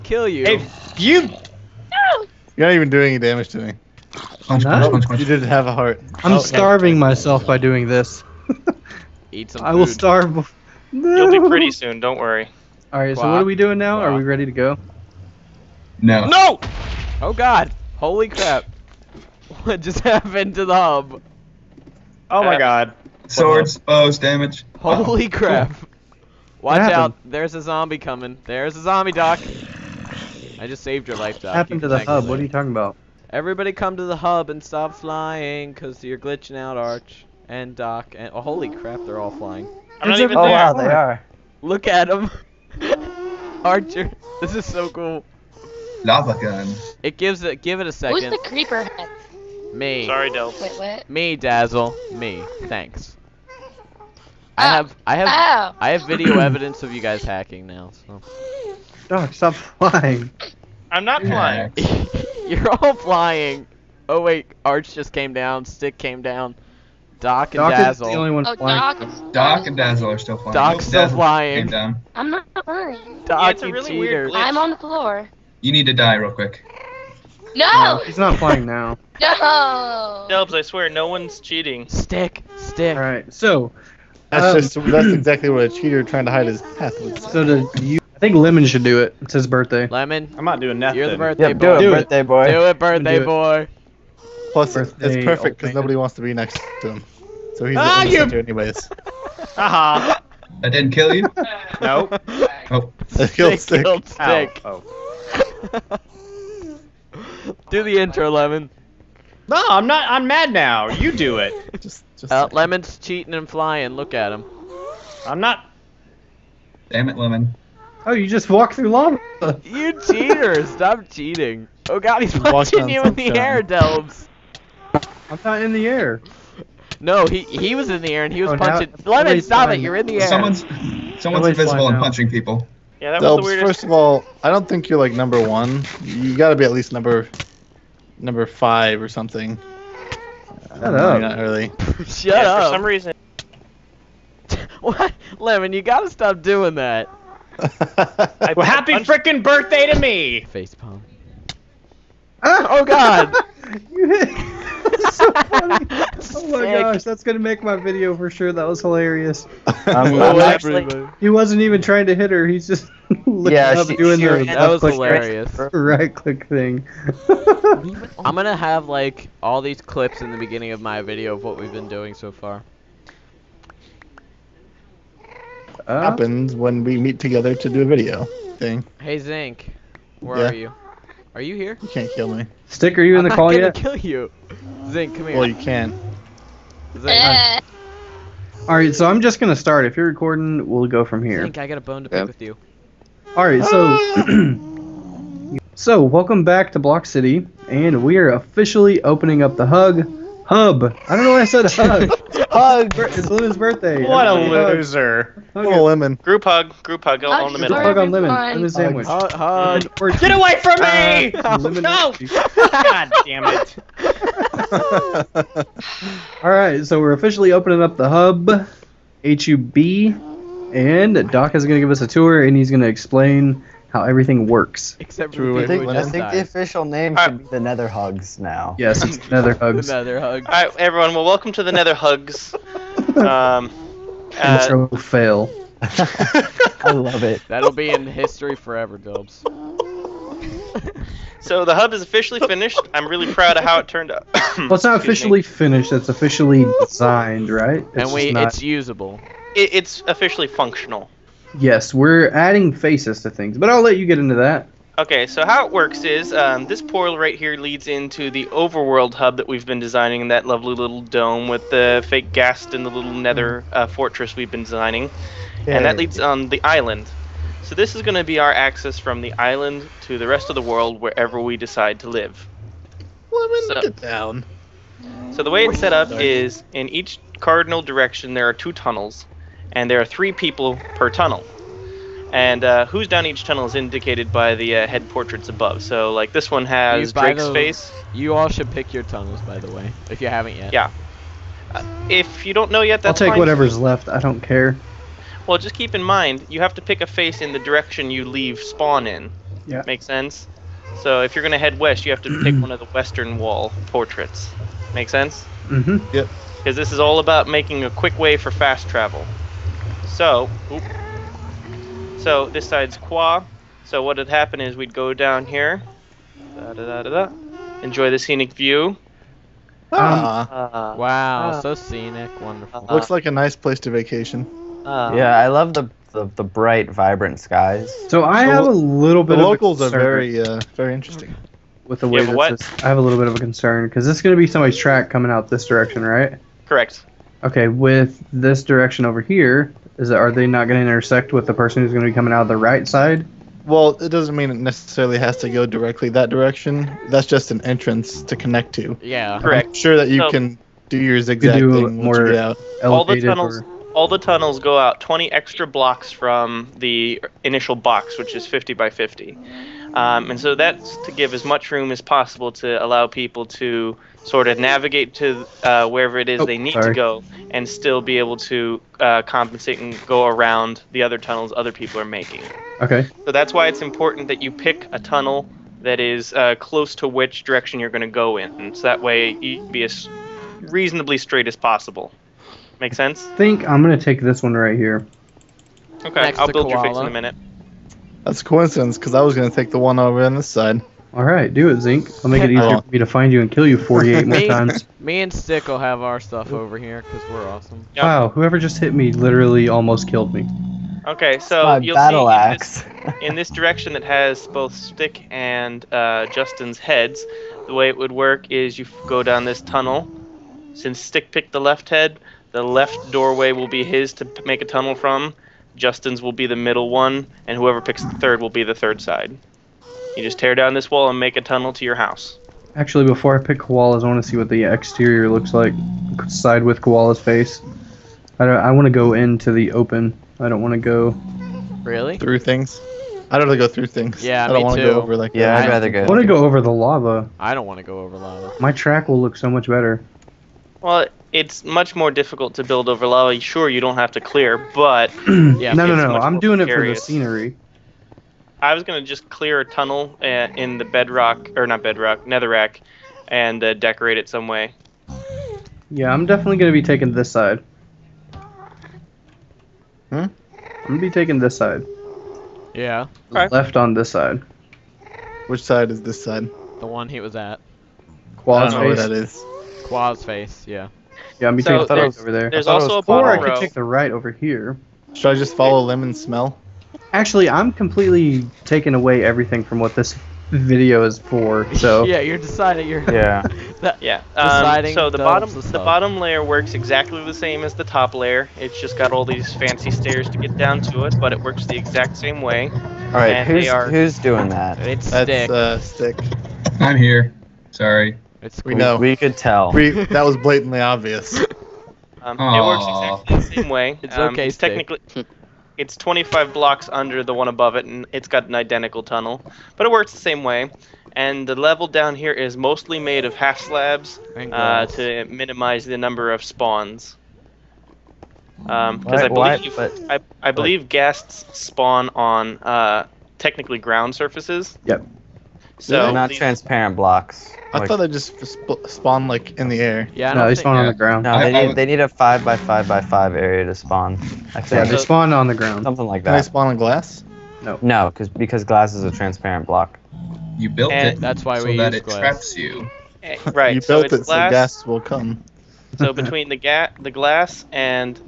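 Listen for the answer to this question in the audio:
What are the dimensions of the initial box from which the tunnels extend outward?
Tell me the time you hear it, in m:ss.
5:58.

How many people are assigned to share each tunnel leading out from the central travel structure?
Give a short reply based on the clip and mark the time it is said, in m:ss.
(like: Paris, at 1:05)
3, at 4:40.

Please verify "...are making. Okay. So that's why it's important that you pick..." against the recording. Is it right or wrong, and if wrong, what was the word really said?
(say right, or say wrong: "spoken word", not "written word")
right.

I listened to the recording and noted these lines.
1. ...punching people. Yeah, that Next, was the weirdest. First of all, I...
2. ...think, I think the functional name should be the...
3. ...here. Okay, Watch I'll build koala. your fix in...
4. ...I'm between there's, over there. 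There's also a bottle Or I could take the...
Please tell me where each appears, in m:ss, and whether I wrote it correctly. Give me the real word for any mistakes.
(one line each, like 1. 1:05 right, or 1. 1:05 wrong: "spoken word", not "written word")
1. 2:11 wrong: "Delbs", not "Next"
2. 3:45 wrong: "official", not "functional"
3. 6:24 wrong: "Next", not "Watch"
4. 7:51 right.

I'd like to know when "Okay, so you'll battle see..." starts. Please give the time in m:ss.
6:41.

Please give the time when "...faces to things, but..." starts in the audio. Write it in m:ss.
4:12.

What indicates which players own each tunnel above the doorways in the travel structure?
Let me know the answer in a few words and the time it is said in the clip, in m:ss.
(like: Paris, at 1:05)
Head portraits, at 4:44.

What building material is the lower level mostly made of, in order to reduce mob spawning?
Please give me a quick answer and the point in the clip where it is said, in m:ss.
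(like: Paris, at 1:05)
Half slabs, at 8:33.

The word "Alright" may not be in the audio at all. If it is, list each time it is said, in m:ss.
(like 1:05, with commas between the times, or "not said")
1:22.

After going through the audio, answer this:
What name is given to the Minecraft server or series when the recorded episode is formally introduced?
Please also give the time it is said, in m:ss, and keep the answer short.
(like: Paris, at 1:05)
Block City, at 3:16.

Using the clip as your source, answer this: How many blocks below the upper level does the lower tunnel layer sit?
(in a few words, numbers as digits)
25.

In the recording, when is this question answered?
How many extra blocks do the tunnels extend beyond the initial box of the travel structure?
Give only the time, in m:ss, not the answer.
5:54.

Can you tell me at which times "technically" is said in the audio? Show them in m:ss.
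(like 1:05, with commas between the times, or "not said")
8:24, 8:43.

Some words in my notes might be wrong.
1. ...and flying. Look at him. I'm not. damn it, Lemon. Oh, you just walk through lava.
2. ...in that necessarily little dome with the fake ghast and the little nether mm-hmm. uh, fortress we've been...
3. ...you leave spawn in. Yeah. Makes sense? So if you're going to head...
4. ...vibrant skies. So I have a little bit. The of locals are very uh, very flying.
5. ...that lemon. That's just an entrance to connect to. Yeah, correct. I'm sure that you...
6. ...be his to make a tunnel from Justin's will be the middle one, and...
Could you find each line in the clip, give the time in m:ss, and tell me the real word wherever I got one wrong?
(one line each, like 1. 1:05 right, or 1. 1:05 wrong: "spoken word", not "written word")
1. 1:53 right
2. 4:20 wrong: "lovely", not "necessarily"
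3. 4:58 right
4. 5:26 wrong: "interesting", not "flying"
5. 5:46 wrong: "direction", not "lemon"
6. 6:53 right.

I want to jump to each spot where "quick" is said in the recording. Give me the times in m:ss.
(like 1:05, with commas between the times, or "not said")
1:16, 5:07.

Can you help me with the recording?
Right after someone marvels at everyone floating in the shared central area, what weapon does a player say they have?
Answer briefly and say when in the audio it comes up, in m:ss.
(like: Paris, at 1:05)
Lava gun, at 0:46.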